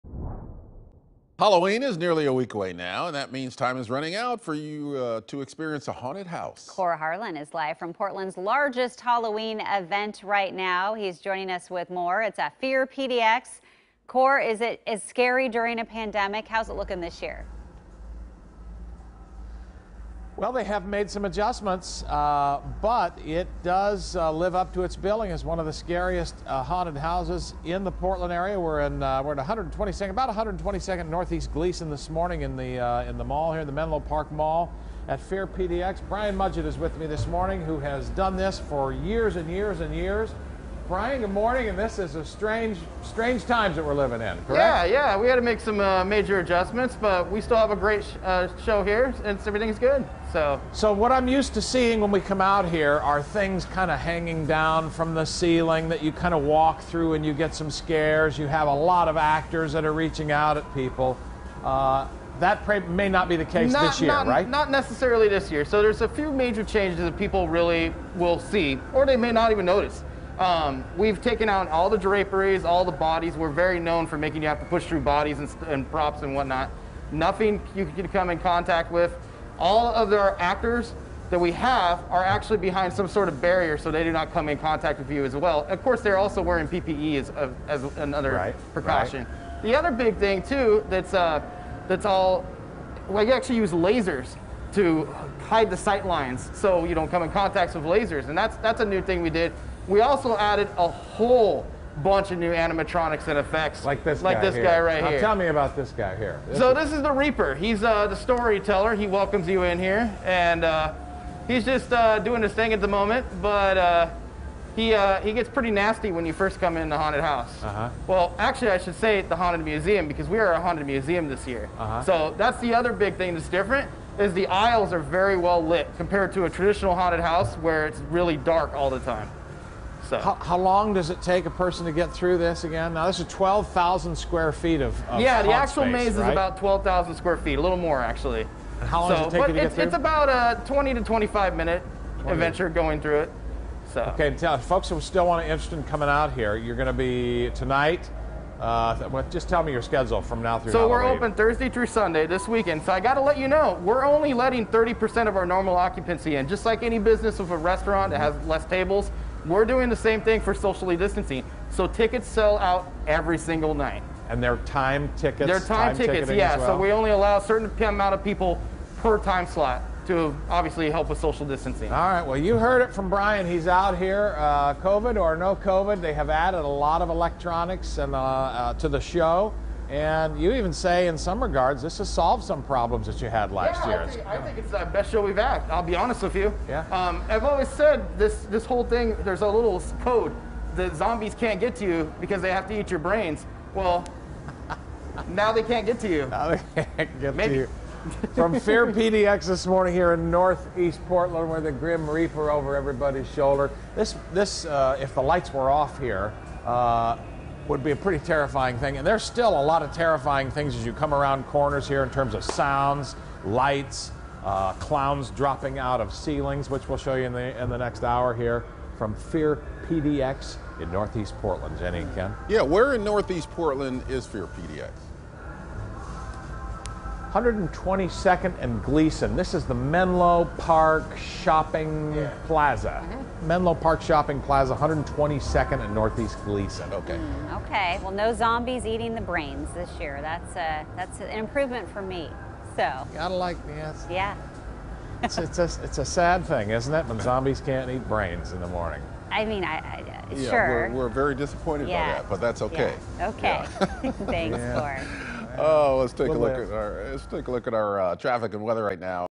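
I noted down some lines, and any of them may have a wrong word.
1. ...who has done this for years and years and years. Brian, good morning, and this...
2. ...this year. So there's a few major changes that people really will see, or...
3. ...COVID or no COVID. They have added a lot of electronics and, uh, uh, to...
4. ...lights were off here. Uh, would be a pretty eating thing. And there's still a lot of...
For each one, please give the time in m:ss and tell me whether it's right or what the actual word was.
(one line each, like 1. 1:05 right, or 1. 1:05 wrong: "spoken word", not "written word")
1. 0:37 right
2. 1:05 right
3. 2:54 right
4. 3:25 wrong: "terrifying", not "eating".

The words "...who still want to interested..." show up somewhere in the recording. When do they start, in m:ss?
2:24.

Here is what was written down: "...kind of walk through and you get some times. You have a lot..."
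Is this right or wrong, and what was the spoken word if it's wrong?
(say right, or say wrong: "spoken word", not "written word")
wrong: "scares", not "times".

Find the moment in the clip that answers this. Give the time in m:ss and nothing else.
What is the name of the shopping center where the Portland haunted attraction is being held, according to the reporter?
0:33.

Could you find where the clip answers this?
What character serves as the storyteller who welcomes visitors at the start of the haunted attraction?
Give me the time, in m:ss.
1:47.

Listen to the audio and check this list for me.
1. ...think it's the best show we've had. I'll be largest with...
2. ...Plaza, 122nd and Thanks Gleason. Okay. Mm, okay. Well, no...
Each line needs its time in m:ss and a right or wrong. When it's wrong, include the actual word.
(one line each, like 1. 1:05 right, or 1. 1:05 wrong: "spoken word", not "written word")
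1. 3:04 wrong: "honest", not "largest"
2. 3:54 wrong: "Northeast", not "Thanks".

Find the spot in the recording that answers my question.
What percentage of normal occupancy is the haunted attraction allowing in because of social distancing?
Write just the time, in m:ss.
2:34.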